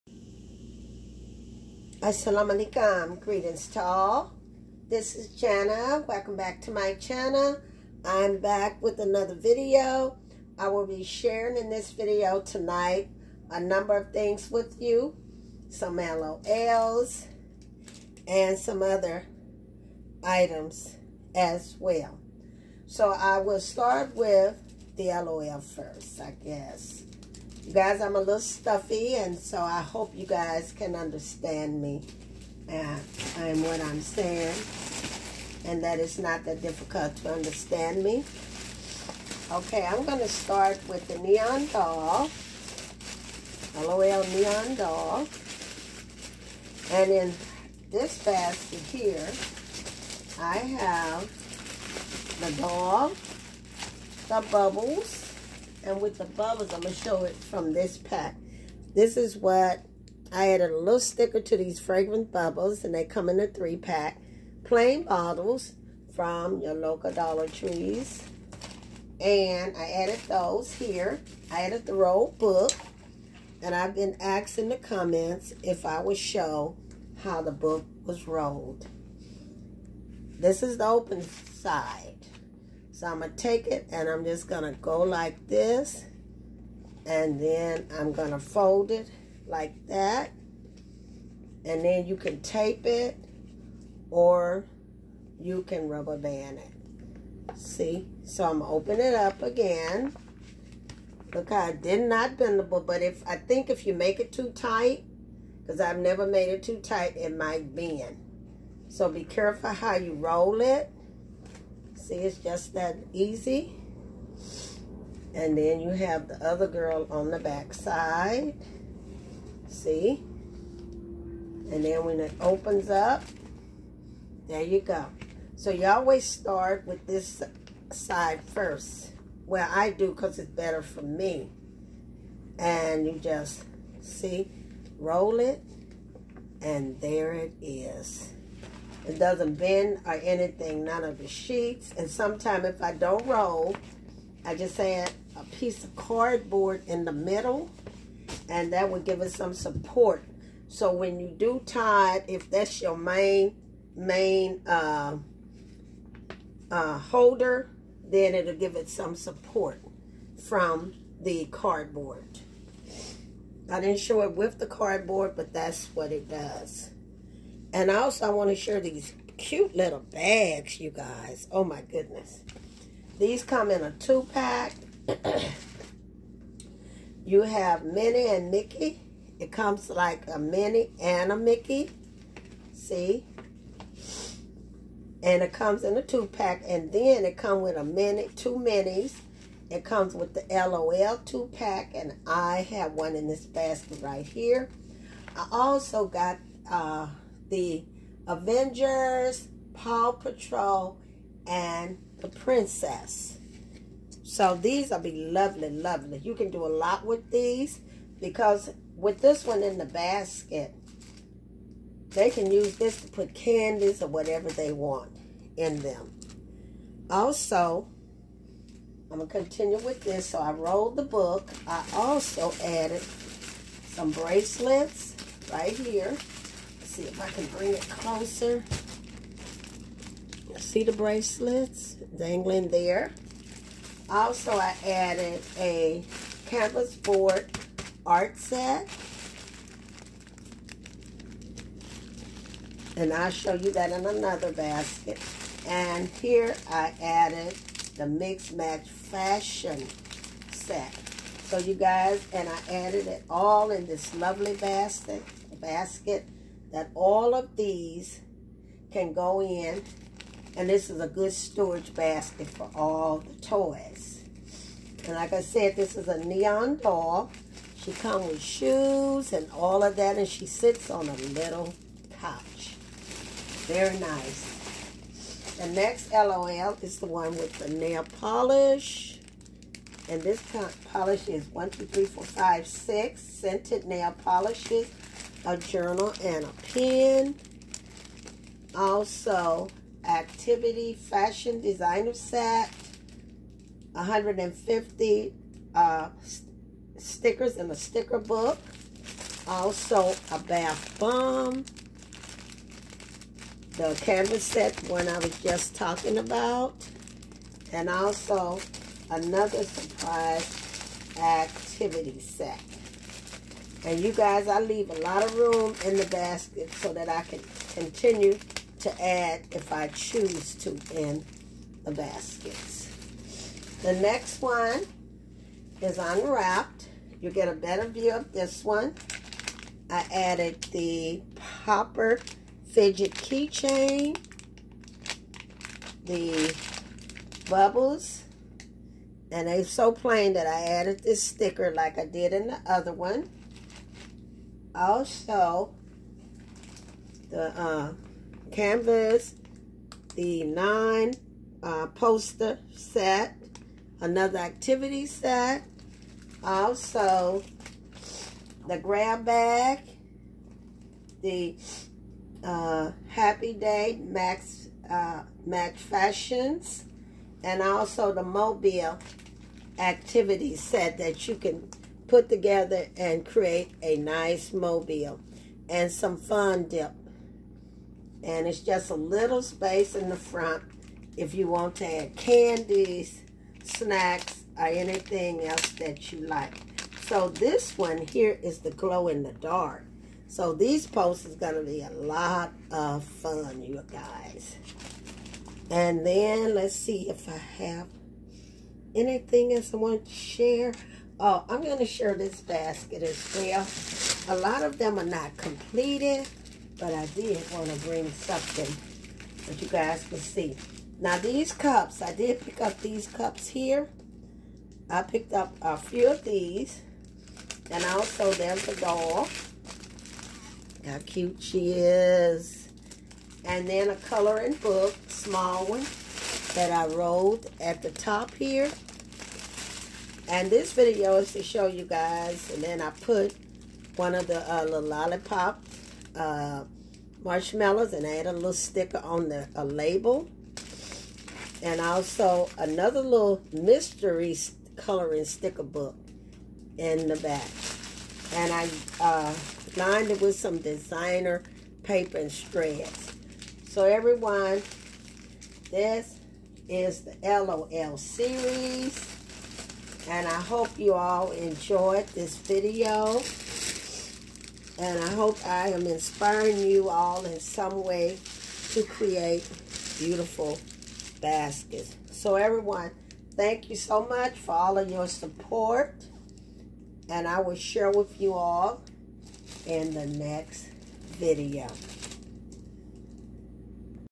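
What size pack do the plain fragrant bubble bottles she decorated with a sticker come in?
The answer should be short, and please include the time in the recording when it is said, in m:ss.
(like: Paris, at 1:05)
3-pack, at 1:03.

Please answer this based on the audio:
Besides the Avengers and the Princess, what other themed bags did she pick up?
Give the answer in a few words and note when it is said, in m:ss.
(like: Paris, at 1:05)
Paw Patrol, at 3:19.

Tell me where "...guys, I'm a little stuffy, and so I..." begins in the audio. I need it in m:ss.
0:27.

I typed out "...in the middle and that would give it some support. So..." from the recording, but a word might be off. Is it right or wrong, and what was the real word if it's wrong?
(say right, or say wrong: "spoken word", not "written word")
right.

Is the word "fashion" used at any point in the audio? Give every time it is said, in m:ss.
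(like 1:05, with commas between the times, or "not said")
4:08, 4:50, 6:05.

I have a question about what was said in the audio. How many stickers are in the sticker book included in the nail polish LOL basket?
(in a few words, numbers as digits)
150.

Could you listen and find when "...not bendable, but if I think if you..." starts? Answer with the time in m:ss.
1:42.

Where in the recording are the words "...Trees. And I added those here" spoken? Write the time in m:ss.
1:07.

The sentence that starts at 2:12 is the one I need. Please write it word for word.
And you just, see, roll it, and there it is.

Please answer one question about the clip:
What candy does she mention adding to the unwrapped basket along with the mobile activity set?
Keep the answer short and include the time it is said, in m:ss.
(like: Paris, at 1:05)
fun dip, at 6:16.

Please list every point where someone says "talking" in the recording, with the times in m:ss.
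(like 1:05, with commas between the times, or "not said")
5:05.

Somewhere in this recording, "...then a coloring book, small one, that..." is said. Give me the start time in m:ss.
7:03.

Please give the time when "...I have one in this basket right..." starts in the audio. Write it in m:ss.
3:12.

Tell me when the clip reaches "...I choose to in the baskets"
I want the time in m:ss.
5:19.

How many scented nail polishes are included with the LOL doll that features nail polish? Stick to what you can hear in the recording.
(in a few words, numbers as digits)
6.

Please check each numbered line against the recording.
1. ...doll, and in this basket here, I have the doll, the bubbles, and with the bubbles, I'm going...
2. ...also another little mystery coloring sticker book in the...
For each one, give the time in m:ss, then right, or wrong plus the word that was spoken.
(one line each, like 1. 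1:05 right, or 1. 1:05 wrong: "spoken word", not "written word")
1. 0:44 right
2. 7:21 right.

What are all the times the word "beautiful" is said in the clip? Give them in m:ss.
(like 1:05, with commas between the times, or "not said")
7:49.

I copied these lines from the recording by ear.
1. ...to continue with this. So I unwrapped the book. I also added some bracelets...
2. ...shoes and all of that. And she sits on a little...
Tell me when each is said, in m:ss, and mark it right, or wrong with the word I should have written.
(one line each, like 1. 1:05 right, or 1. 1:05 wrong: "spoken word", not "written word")
1. 3:39 wrong: "rolled", not "unwrapped"
2. 4:28 right.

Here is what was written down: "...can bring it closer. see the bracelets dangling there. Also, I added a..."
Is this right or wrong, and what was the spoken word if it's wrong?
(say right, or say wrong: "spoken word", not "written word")
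right.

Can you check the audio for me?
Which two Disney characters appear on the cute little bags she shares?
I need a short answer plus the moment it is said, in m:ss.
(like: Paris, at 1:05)
Minnie and Mickey, at 2:57.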